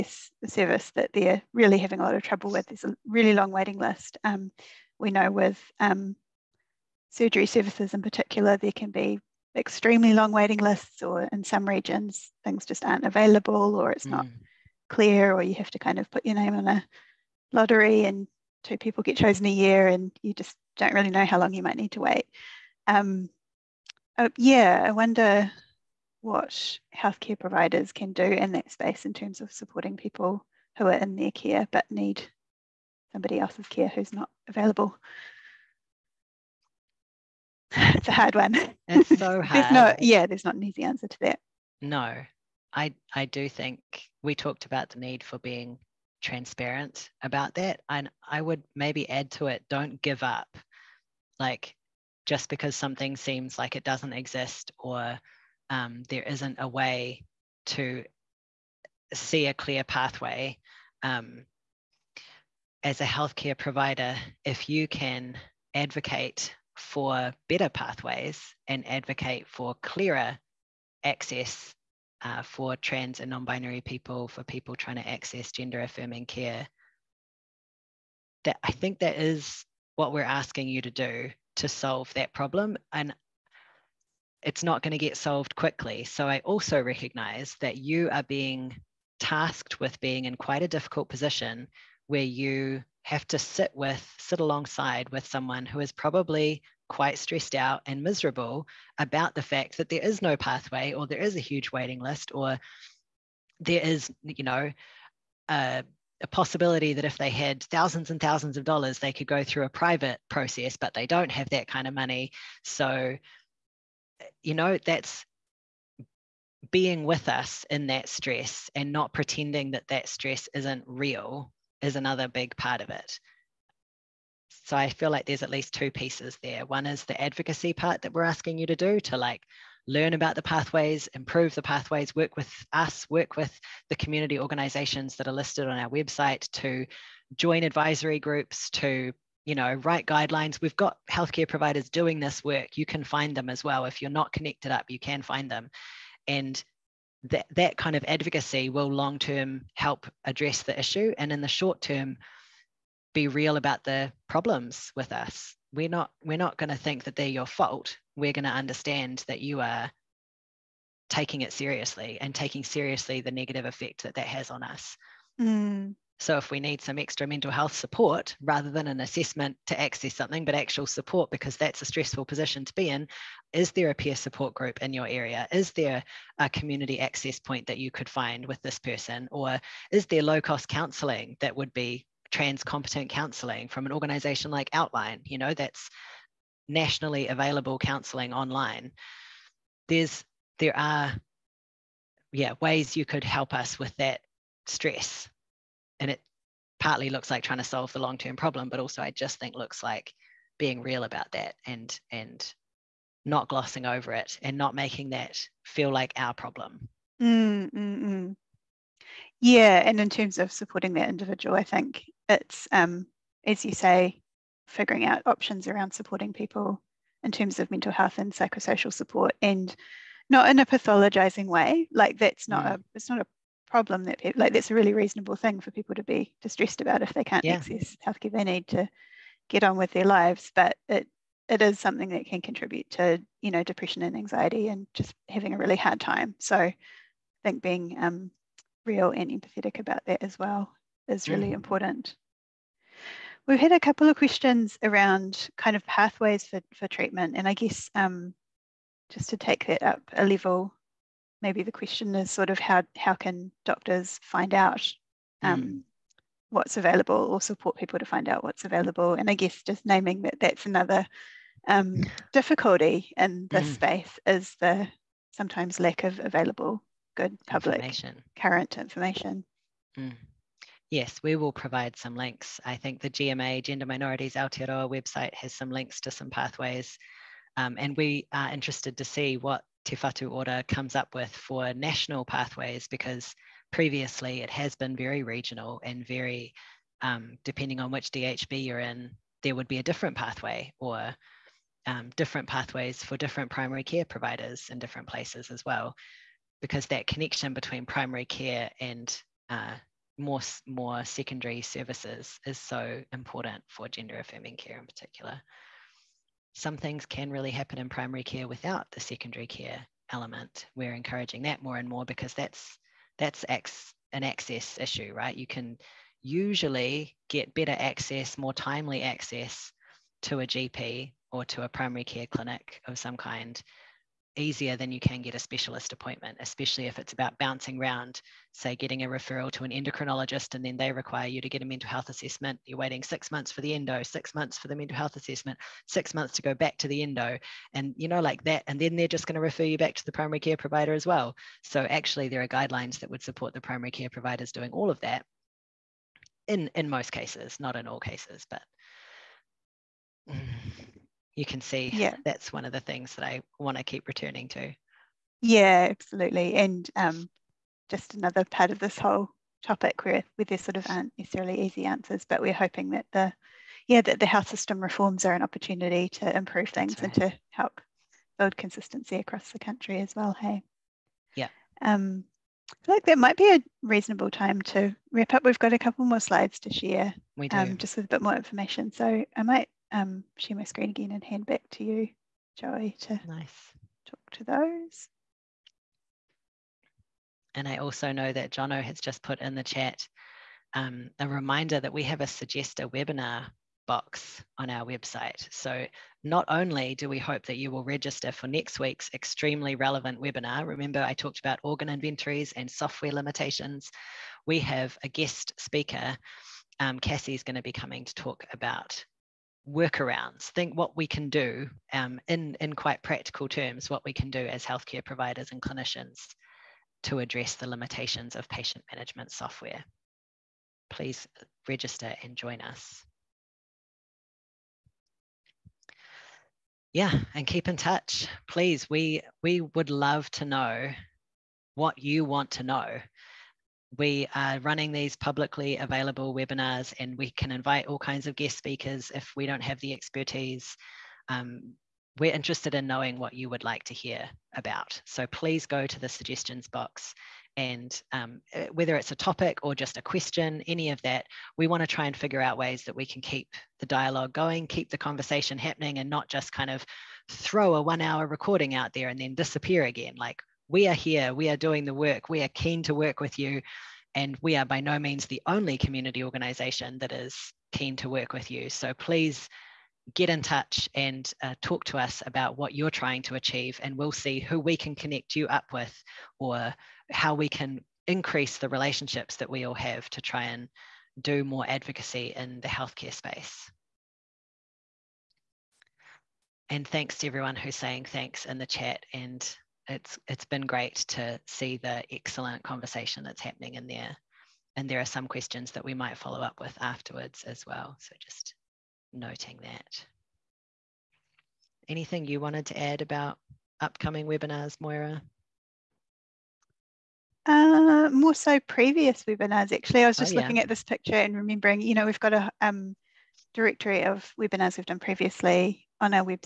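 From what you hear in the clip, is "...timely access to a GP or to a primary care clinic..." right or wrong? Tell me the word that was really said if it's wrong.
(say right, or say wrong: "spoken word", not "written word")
right.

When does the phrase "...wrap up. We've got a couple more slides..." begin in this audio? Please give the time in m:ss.
6:15.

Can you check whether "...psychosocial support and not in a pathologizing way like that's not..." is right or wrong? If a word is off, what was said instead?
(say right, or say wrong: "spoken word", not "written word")
right.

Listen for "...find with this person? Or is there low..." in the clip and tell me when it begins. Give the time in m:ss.
2:58.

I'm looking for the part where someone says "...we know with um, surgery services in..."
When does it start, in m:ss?
0:04.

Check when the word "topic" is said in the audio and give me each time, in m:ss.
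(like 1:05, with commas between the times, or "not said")
5:59, 7:29.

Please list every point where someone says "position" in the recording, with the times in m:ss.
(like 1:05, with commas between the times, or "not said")
1:31, 2:52.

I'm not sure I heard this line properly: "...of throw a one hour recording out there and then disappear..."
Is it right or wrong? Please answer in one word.
right.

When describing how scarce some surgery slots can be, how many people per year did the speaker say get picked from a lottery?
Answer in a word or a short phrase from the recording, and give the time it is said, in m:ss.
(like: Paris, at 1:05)
2, at 0:18.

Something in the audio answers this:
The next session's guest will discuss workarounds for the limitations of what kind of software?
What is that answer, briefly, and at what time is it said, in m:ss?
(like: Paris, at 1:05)
patient management software, at 6:58.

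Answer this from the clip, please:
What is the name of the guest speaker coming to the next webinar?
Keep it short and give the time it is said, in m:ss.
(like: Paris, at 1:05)
Cassie, at 6:46.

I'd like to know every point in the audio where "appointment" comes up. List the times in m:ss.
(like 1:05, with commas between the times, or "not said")
5:25.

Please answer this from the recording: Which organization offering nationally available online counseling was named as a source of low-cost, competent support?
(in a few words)
Outline.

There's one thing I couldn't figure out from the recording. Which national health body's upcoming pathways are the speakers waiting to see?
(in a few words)
Te Whatu Ora.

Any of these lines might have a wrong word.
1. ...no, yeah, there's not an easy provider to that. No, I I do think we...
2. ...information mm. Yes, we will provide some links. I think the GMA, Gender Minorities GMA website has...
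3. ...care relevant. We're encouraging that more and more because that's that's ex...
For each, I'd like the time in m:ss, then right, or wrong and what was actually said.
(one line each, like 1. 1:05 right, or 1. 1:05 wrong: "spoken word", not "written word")
1. 0:39 wrong: "answer", not "provider"
2. 4:28 wrong: "Aotearoa", not "GMA"
3. 5:09 wrong: "element", not "relevant".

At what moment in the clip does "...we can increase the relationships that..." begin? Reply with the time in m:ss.
7:57.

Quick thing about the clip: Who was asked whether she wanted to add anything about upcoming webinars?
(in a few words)
Moira.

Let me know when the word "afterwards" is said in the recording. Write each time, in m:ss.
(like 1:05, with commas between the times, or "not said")
8:16.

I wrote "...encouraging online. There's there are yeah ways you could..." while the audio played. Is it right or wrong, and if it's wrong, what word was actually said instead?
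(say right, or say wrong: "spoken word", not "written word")
wrong: "counseling", not "encouraging".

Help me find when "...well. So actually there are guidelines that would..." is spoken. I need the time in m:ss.
5:41.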